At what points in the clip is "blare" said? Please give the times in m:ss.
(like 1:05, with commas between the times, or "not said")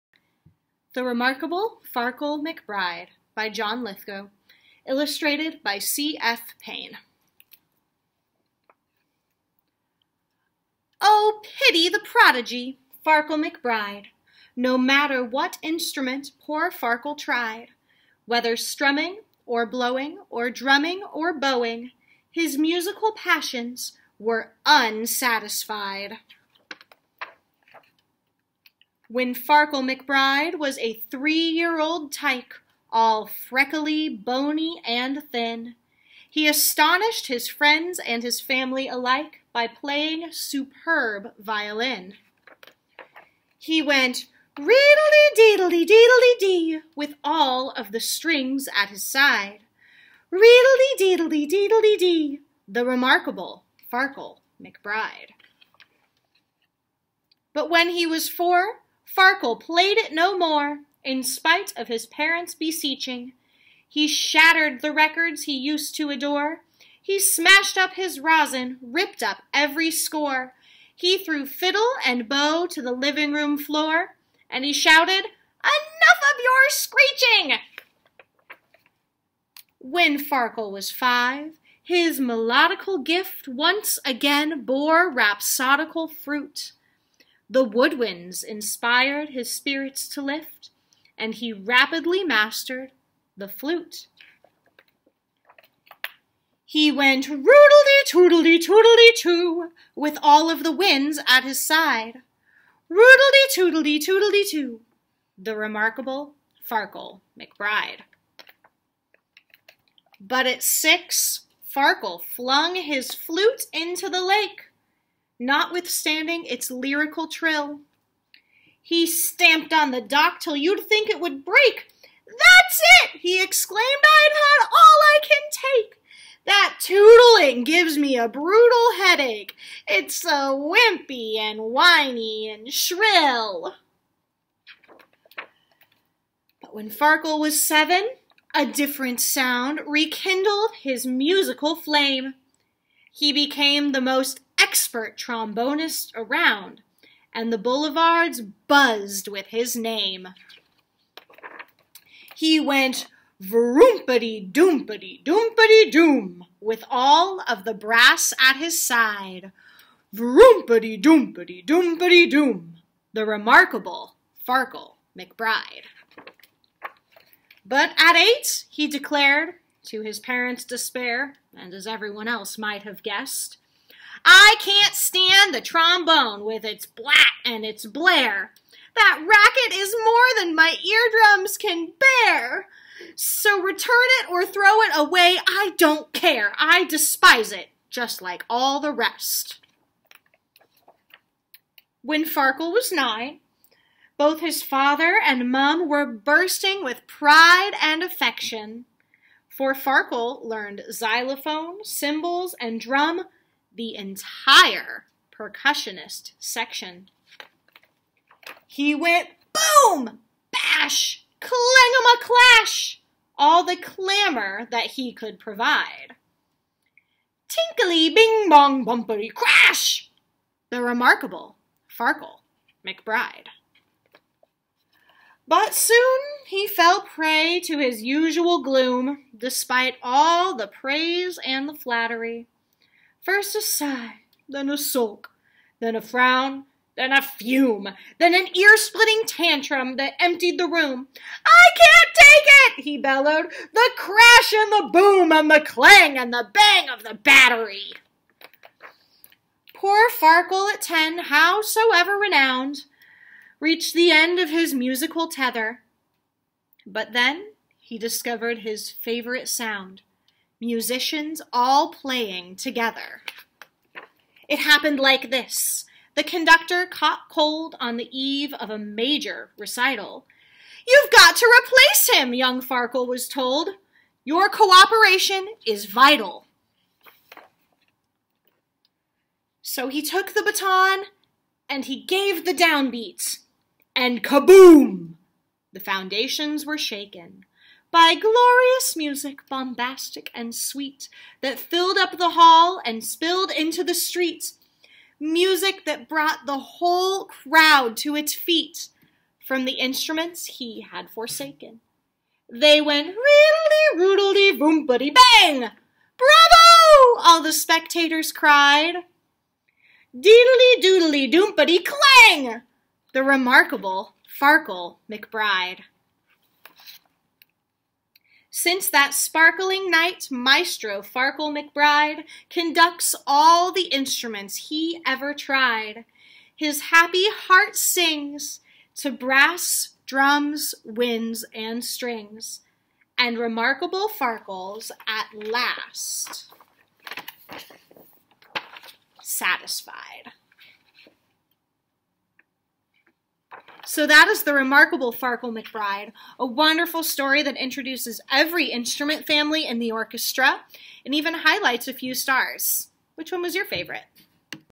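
2:57.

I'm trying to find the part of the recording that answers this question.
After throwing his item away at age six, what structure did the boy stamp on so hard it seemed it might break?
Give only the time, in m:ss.
1:59.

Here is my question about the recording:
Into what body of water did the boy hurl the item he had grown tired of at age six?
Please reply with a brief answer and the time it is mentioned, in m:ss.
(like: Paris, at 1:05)
the lake, at 1:54.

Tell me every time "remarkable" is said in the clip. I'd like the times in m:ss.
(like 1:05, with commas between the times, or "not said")
0:01, 0:52, 1:45, 2:43, 3:40, 5:13, 5:33, 5:44.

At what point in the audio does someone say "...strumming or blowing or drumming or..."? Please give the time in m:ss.
0:18.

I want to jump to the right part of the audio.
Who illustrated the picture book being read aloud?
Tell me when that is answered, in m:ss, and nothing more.
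0:05.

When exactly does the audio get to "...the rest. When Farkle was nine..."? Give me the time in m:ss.
3:08.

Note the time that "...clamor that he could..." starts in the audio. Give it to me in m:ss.
3:33.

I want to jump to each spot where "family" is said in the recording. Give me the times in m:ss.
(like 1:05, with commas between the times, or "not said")
0:38, 5:49.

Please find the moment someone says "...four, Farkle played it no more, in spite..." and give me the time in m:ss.
0:58.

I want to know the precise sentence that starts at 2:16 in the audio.
But when Farkle was seven, a different sound rekindled his musical flame.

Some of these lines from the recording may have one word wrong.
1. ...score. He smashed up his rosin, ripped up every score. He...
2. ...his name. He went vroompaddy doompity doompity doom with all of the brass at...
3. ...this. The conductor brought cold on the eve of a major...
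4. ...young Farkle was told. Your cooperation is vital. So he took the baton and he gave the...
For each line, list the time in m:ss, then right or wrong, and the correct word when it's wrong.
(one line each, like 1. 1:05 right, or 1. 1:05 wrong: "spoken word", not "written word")
1. 1:06 wrong: "adore", not "score"
2. 2:29 right
3. 4:25 wrong: "caught", not "brought"
4. 4:32 right.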